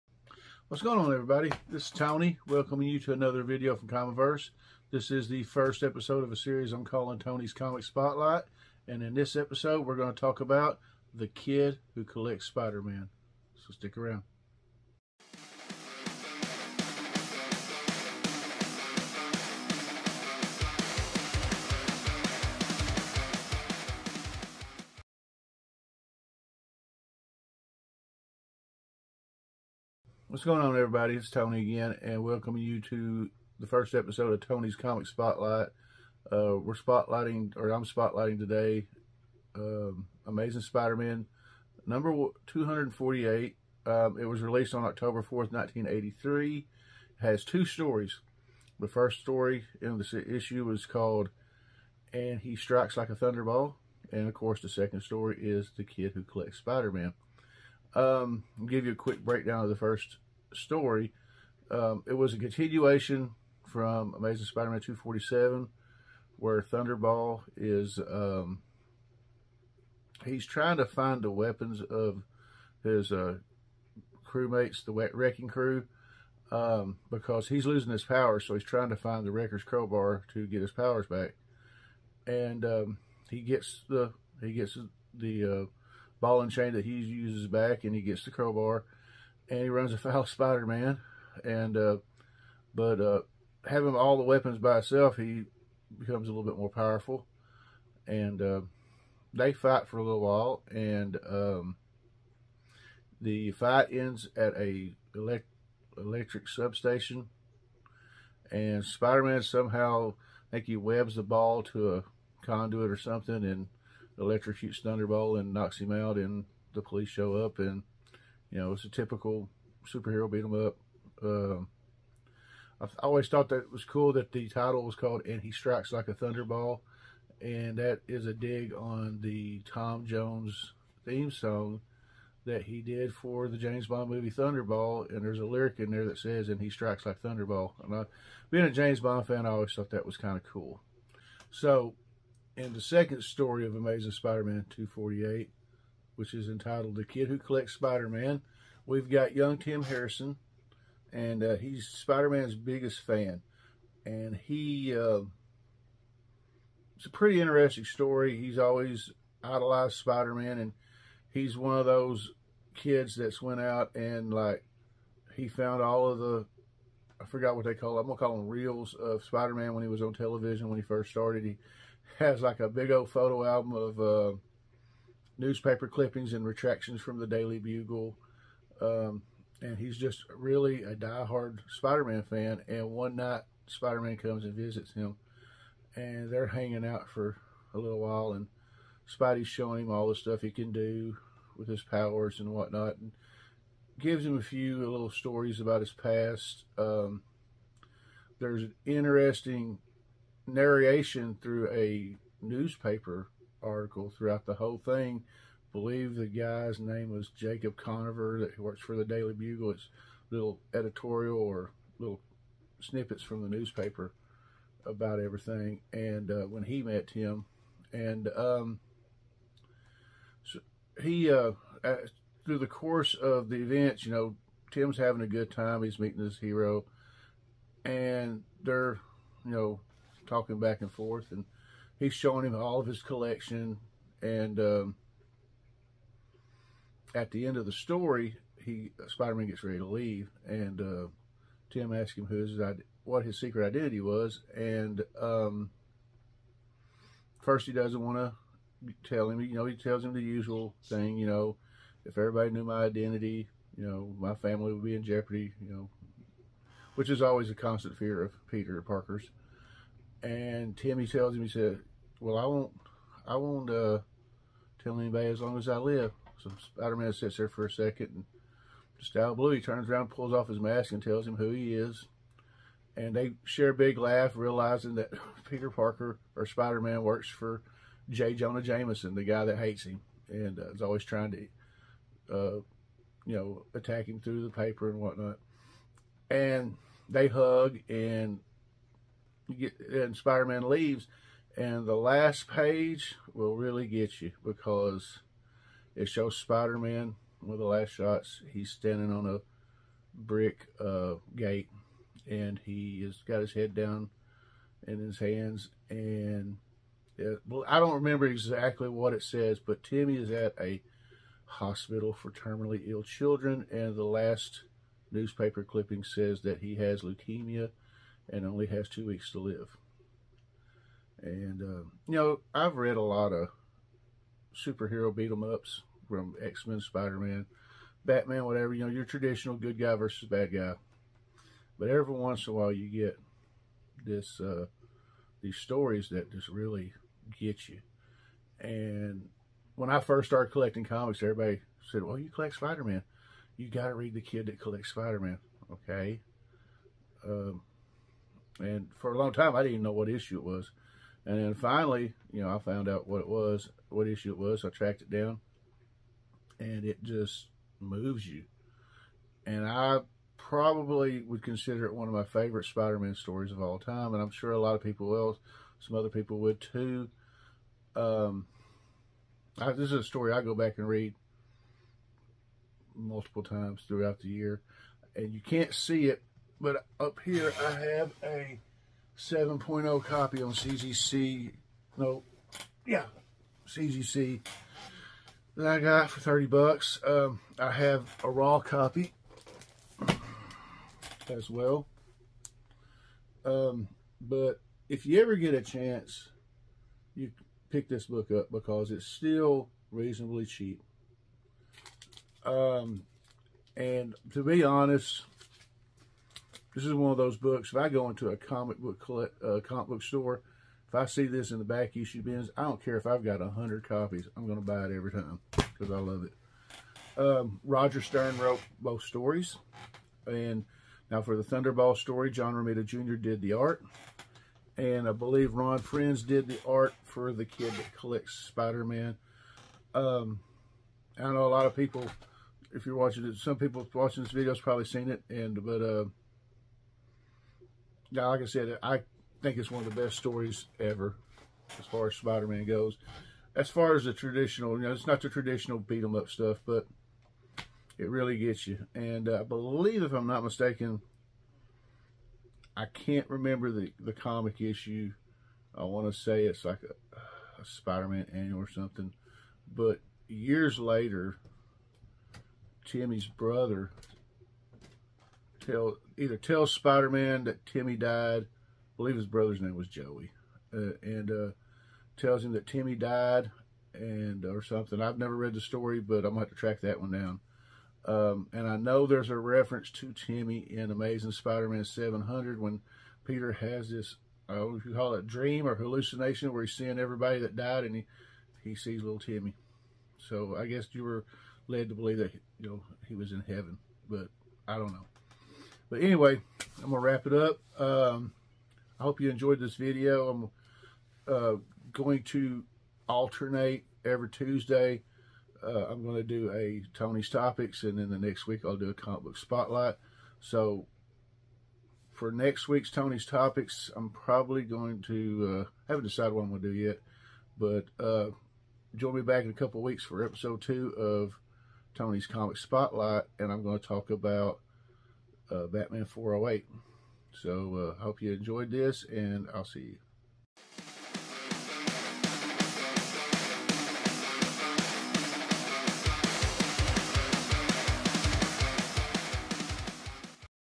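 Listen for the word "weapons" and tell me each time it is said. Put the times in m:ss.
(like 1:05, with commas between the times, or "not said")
1:11, 1:34.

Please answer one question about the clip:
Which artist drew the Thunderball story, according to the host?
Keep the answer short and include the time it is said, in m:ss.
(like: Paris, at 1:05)
John Romita Jr., at 7:02.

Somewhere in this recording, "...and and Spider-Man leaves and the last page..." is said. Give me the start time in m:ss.
4:47.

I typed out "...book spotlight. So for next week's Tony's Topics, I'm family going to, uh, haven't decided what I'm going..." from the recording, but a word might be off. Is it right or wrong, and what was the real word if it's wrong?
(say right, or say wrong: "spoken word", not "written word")
wrong: "probably", not "family".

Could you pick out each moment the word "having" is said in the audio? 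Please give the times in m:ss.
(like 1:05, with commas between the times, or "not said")
1:33, 3:44.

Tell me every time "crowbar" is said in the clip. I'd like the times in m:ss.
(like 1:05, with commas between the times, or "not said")
1:19, 1:28.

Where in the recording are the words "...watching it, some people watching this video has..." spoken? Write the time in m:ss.
7:12.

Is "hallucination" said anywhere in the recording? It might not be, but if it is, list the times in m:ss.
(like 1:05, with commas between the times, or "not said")
8:05.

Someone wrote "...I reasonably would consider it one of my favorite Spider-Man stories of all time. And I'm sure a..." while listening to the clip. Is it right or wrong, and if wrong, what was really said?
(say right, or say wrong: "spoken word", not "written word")
wrong: "probably", not "reasonably".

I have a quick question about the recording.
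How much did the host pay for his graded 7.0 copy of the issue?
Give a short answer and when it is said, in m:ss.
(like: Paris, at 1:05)
$30, at 6:26.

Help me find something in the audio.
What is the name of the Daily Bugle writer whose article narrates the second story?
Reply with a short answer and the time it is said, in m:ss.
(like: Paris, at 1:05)
Jacob Conover, at 3:27.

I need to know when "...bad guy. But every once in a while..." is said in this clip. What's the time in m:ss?
5:30.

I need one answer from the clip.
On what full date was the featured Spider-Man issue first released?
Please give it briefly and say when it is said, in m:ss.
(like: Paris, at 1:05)
October 4th, 1983, at 0:44.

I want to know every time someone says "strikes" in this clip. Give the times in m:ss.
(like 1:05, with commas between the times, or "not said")
0:52, 2:05, 2:16.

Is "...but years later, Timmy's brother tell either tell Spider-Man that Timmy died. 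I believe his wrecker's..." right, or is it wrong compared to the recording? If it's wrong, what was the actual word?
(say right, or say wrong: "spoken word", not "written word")
wrong: "brother", not "wrecker".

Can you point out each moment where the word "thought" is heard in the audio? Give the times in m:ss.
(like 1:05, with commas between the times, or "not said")
2:03, 2:19.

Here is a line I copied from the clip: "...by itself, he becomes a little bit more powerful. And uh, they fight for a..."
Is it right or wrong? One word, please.
right.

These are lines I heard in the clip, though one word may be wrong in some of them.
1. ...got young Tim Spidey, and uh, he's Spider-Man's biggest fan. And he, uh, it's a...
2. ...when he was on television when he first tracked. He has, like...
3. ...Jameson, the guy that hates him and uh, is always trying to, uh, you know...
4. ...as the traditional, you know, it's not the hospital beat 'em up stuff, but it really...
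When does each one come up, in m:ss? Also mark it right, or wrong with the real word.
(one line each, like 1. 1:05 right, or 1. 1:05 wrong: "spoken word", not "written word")
1. 2:29 wrong: "Harrison", not "Spidey"
2. 2:49 wrong: "started", not "tracked"
3. 4:38 right
4. 7:23 wrong: "traditional", not "hospital".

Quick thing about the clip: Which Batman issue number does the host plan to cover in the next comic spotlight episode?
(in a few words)
408.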